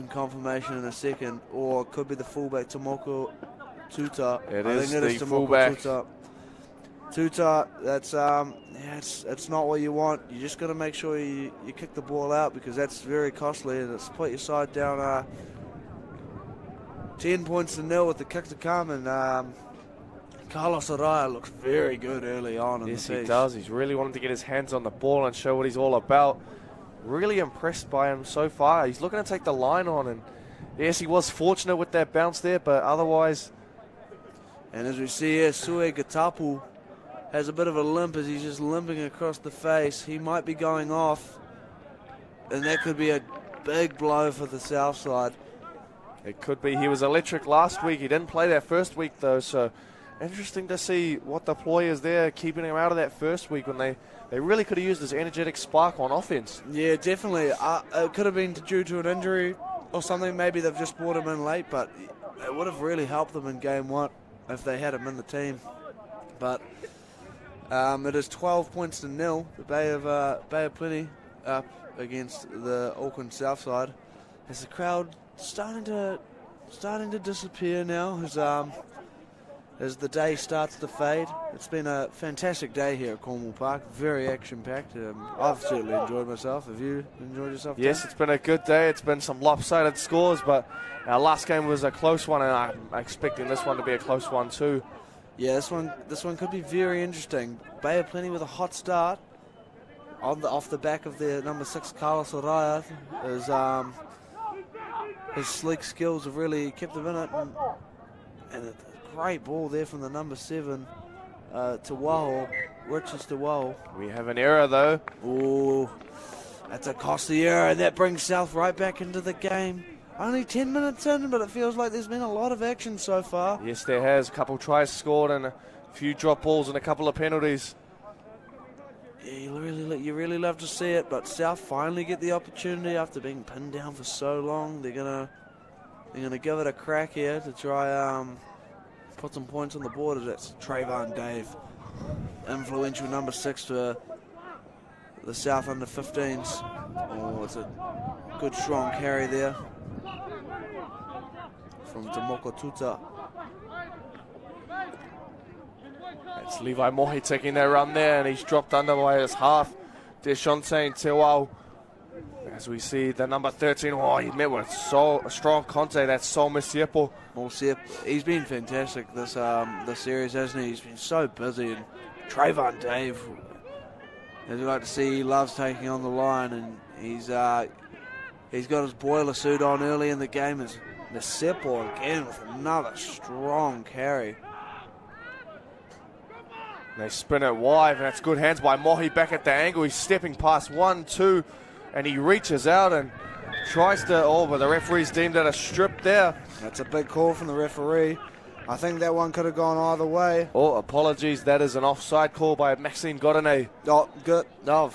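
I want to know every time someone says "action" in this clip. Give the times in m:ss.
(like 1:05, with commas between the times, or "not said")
1:24, 2:02.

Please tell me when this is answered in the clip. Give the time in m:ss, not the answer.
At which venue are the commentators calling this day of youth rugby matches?
1:23.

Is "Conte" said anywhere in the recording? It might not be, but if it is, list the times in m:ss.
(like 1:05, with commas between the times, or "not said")
2:45.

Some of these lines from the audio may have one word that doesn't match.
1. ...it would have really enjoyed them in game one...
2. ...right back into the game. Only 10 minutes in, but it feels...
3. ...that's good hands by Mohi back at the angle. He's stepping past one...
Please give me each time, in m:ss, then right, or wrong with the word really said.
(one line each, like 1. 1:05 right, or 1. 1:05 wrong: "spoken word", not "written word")
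1. 1:02 wrong: "helped", not "enjoyed"
2. 1:58 right
3. 3:08 right.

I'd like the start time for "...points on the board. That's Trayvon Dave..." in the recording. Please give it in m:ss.
2:19.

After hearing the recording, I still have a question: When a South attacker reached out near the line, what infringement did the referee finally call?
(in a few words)
Offside.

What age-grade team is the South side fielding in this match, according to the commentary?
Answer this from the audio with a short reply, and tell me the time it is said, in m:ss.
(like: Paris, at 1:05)
Under 15s, at 2:25.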